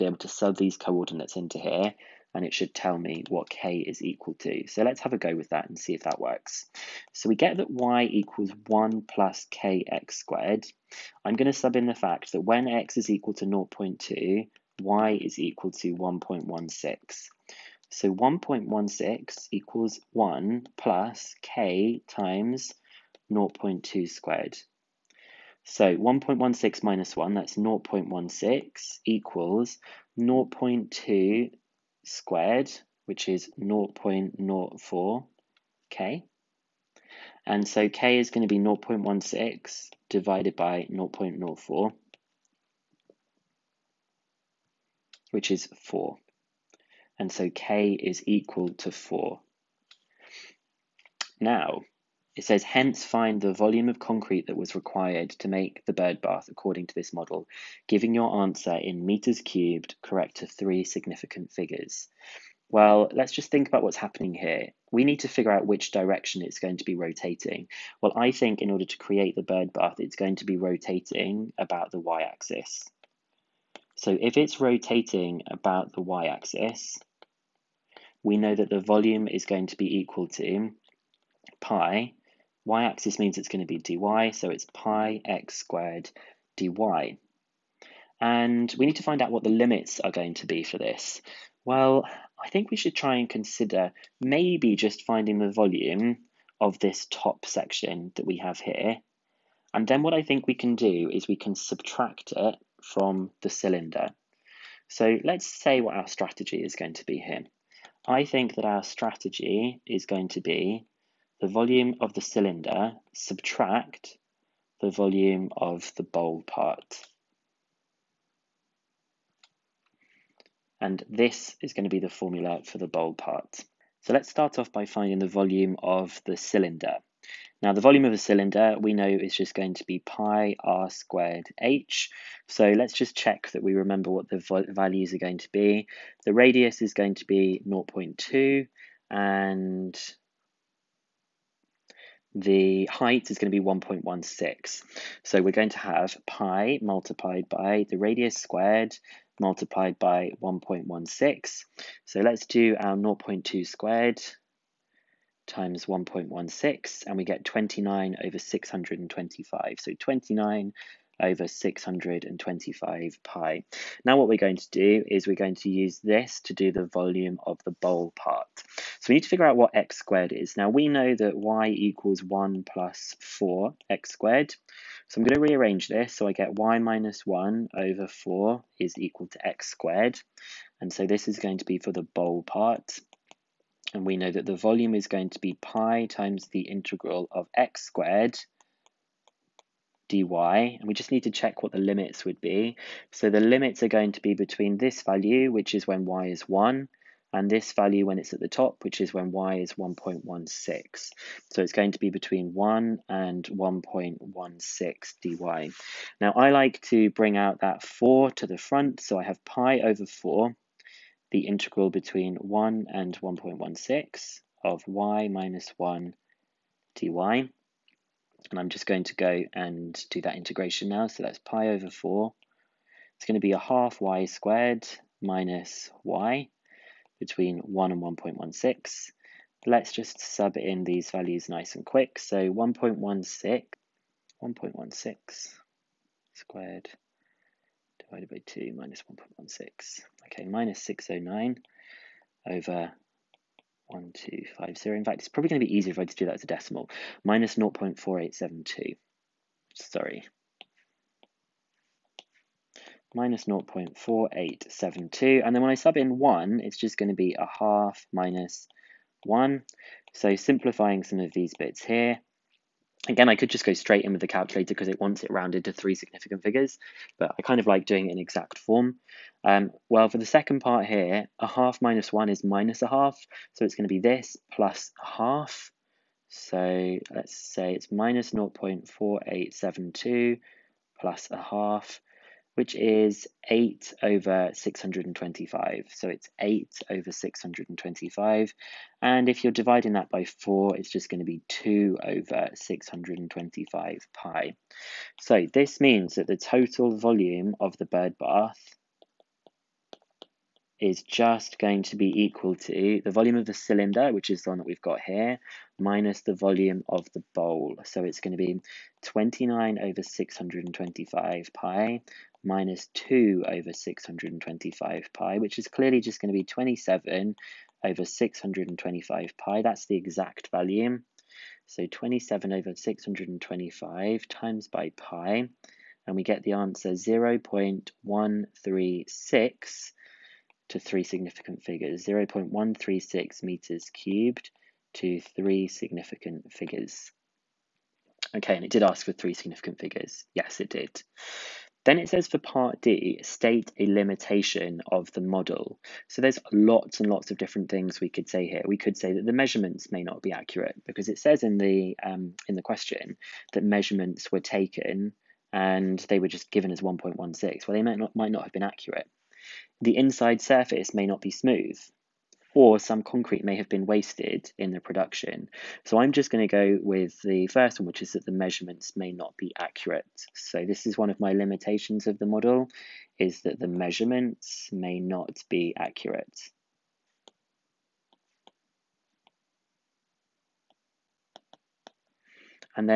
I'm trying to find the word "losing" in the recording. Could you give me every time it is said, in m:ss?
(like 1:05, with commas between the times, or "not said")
not said.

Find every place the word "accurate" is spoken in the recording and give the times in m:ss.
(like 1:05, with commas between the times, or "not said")
5:50, 5:58, 6:09, 6:15.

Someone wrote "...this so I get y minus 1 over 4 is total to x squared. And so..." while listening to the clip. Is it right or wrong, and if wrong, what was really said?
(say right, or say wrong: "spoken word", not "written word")
wrong: "equal", not "total".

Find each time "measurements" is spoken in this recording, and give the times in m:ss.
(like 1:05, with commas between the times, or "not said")
5:49, 5:53, 6:08, 6:13.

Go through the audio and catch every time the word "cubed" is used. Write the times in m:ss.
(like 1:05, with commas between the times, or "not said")
0:59, 5:33.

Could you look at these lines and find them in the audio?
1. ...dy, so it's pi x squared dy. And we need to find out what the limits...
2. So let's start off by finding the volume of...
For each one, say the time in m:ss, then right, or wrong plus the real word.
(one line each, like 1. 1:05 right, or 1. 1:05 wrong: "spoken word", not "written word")
1. 1:23 right
2. 2:04 right.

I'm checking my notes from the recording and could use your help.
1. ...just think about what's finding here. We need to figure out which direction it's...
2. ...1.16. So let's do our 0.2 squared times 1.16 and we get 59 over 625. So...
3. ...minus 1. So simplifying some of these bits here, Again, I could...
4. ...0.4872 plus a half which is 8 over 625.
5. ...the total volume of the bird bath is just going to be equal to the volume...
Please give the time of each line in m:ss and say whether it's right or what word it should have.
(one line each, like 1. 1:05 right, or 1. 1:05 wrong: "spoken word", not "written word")
1. 1:03 wrong: "happening", not "finding"
2. 2:30 wrong: "29", not "59"
3. 4:18 right
4. 4:38 right
5. 4:56 right.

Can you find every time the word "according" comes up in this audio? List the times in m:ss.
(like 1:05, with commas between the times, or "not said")
0:56.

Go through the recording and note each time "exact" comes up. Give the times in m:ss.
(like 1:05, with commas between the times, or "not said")
4:28, 5:19.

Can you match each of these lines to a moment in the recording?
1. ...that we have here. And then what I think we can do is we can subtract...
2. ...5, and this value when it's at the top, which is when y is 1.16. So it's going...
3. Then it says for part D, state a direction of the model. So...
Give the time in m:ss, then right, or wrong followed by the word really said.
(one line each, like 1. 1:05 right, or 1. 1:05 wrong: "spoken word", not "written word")
1. 1:38 right
2. 3:16 wrong: "1", not "5"
3. 5:41 wrong: "limitation", not "direction".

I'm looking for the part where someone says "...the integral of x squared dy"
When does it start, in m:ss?
3:06.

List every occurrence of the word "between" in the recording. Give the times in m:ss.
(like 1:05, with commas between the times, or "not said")
3:14, 3:22, 3:31, 3:47.